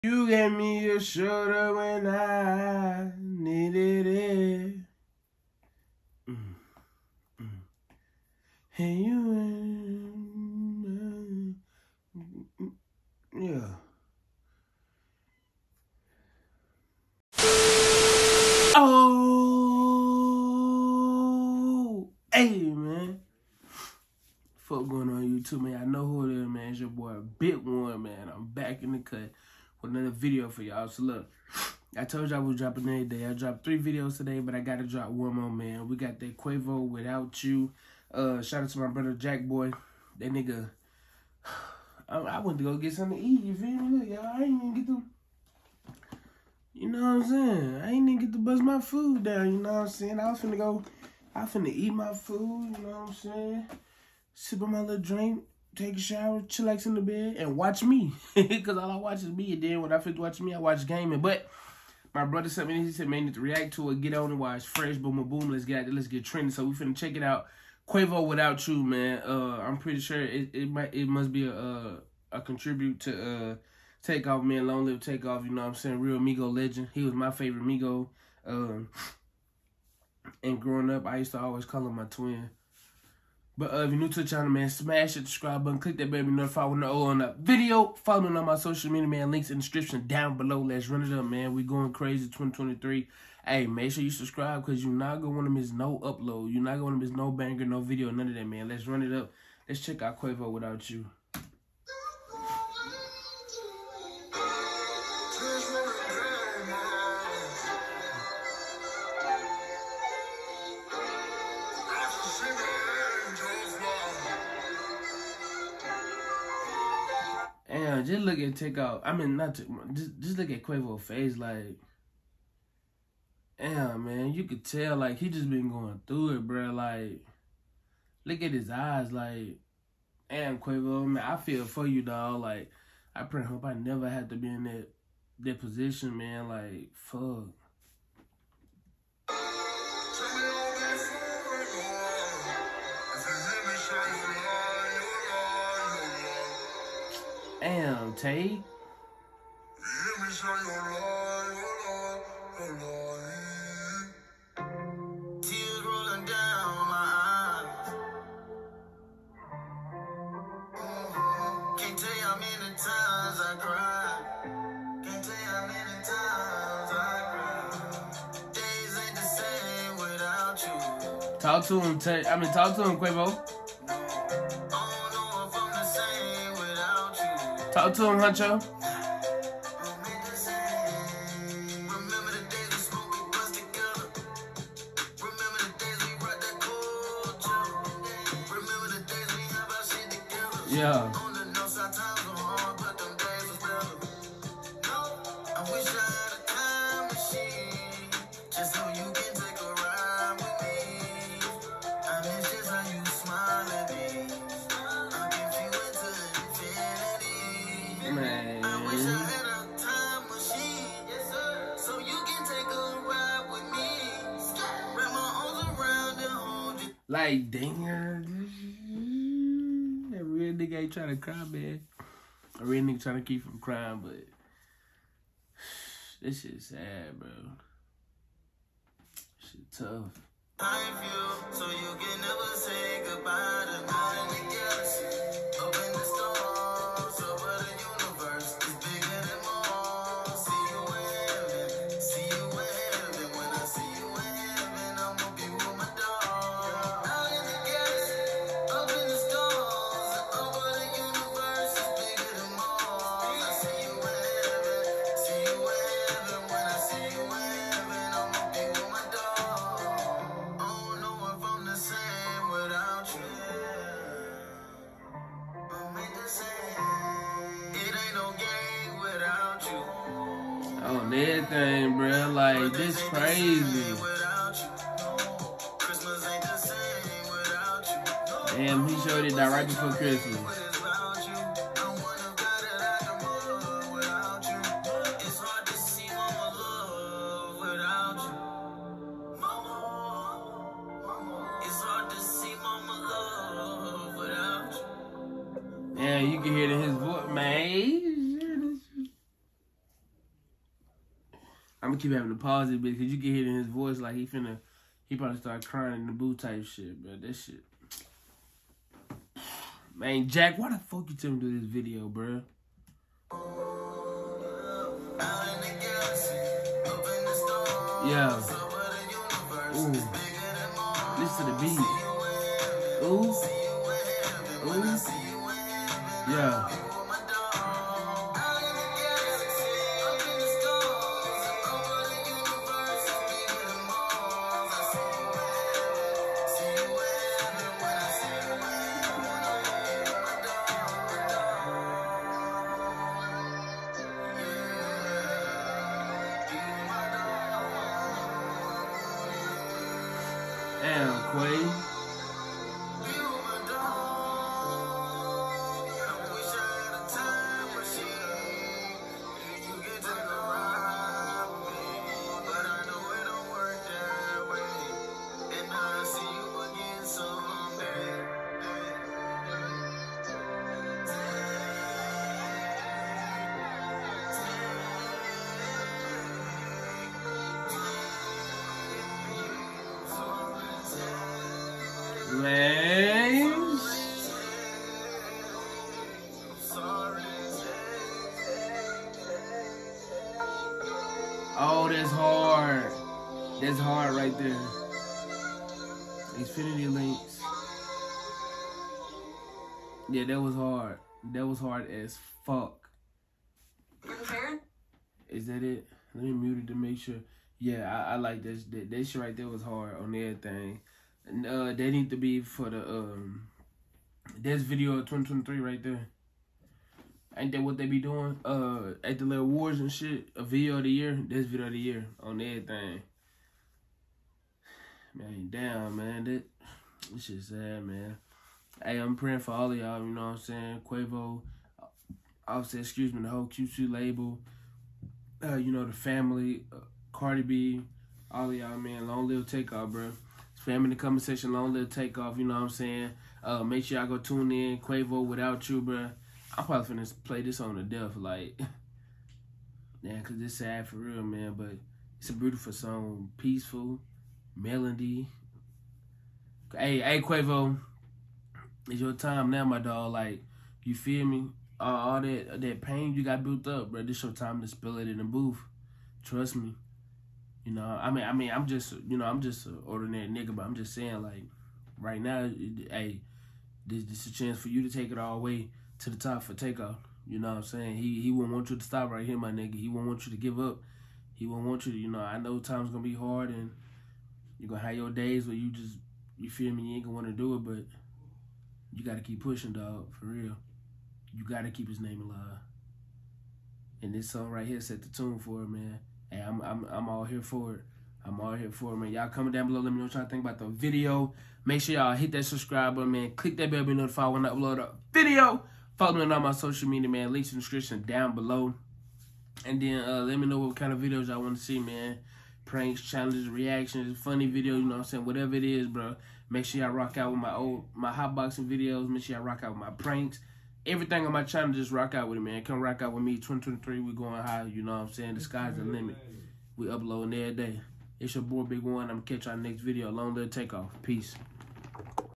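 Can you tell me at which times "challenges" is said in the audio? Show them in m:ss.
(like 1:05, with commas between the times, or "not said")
8:33.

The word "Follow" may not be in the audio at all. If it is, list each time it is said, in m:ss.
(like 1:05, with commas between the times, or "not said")
1:28, 8:25.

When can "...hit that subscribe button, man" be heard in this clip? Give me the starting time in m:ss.
8:22.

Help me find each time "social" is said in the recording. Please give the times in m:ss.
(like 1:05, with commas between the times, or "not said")
1:28, 8:26.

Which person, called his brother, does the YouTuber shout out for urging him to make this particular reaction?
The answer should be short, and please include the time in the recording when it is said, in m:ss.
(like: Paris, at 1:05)
Jack Boy, at 0:39.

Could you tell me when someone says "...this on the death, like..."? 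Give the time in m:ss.
7:27.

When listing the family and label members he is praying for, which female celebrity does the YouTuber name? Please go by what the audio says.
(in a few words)
Cardi B.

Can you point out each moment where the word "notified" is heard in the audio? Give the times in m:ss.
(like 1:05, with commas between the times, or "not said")
1:26, 8:23.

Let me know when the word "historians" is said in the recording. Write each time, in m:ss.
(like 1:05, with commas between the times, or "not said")
not said.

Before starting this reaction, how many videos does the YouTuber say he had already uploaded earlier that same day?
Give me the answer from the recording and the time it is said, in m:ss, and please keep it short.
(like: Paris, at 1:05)
3, at 0:33.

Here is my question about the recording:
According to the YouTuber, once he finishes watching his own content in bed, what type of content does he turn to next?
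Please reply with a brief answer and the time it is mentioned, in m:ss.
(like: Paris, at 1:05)
Gaming, at 1:00.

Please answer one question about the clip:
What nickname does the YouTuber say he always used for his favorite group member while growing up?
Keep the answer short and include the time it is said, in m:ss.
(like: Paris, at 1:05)
My twin, at 1:21.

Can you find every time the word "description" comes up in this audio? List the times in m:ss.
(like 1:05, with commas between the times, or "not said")
1:29, 8:27.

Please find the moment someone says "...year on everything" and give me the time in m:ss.
7:01.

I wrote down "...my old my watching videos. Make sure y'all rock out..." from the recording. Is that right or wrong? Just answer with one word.
wrong.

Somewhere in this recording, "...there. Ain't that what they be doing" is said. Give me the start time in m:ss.
6:55.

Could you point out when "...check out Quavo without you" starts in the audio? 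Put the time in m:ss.
1:39.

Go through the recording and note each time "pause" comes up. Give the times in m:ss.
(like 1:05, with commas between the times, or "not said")
5:02.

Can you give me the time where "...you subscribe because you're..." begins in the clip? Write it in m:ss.
1:34.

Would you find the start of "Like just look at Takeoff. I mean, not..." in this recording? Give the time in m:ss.
1:58.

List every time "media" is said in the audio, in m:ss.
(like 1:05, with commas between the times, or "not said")
1:28, 8:26.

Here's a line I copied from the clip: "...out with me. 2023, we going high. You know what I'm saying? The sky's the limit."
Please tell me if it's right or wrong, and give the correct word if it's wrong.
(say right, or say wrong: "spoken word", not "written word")
right.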